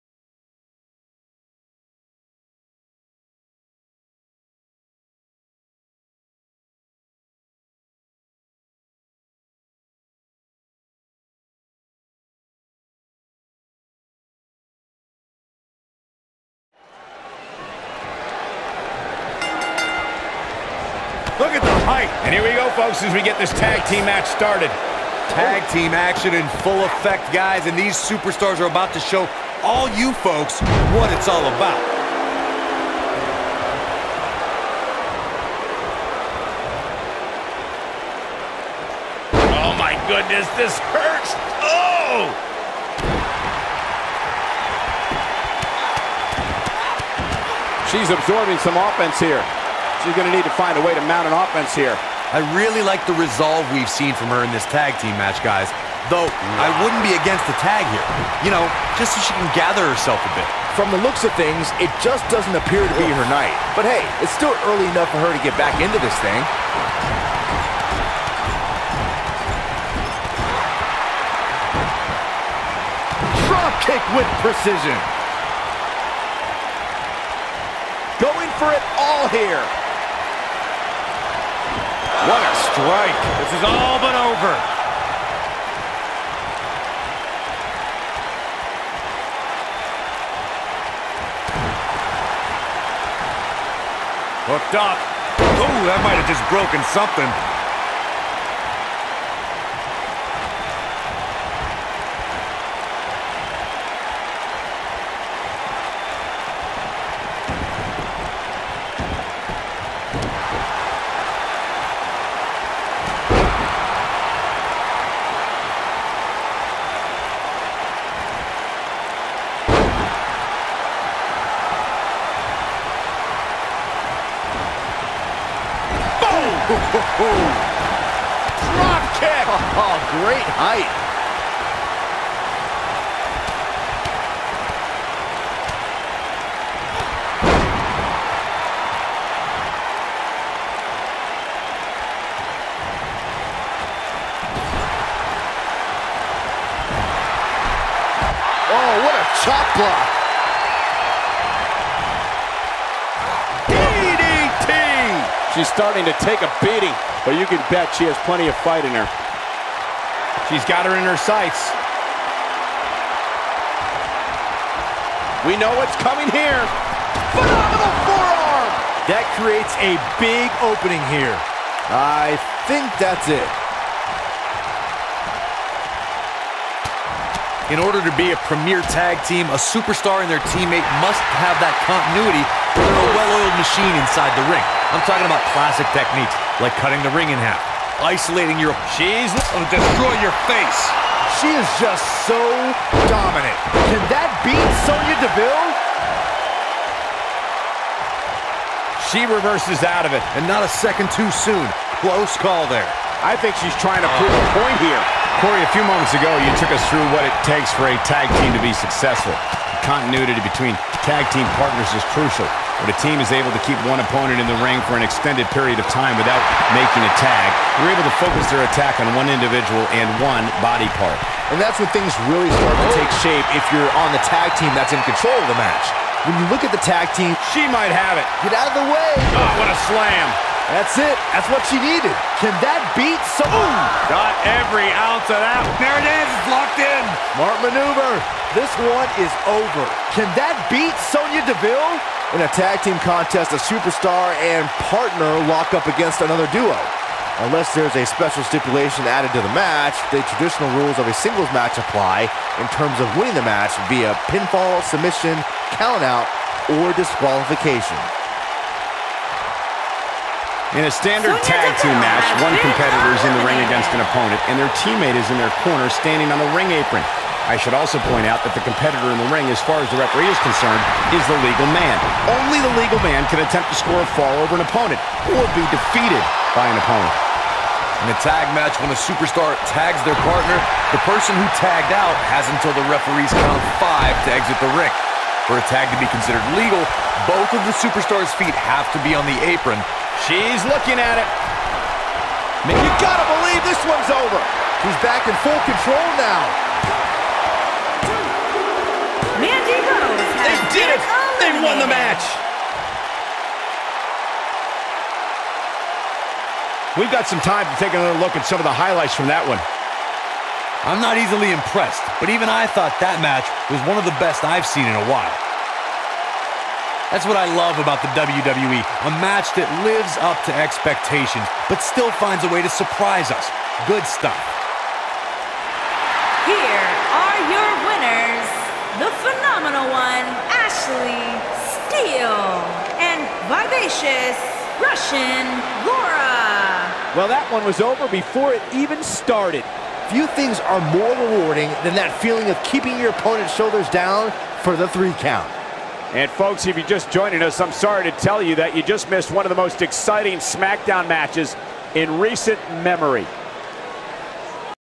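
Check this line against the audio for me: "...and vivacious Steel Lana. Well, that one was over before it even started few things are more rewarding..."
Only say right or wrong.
wrong.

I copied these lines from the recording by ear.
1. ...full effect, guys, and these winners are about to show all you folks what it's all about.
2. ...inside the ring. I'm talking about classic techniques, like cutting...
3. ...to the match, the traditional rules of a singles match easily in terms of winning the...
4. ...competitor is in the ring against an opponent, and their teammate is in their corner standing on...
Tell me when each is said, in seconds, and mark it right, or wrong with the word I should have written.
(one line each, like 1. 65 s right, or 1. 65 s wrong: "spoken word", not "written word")
1. 26 s wrong: "superstars", not "winners"
2. 183 s right
3. 249 s wrong: "apply", not "easily"
4. 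262 s right.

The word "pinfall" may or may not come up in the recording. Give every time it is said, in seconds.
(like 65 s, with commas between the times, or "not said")
254 s.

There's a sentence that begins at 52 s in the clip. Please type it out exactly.
I really like the resolve we've seen from her in this tag team match, guys.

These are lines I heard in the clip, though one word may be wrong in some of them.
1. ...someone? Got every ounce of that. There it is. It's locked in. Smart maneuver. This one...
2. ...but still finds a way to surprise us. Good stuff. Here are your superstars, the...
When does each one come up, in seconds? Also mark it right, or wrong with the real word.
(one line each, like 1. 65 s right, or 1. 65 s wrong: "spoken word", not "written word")
1. 233 s right
2. 321 s wrong: "winners", not "superstars".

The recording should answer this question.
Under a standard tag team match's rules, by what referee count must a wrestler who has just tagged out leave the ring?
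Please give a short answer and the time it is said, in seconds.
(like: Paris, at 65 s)
5, at 283 s.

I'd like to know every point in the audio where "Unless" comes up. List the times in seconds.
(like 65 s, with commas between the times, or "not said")
247 s.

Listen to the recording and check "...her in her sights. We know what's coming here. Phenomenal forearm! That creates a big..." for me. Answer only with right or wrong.
right.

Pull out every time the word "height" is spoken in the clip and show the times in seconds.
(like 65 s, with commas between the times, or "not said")
21 s, 130 s.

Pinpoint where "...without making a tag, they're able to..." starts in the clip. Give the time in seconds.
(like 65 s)
216 s.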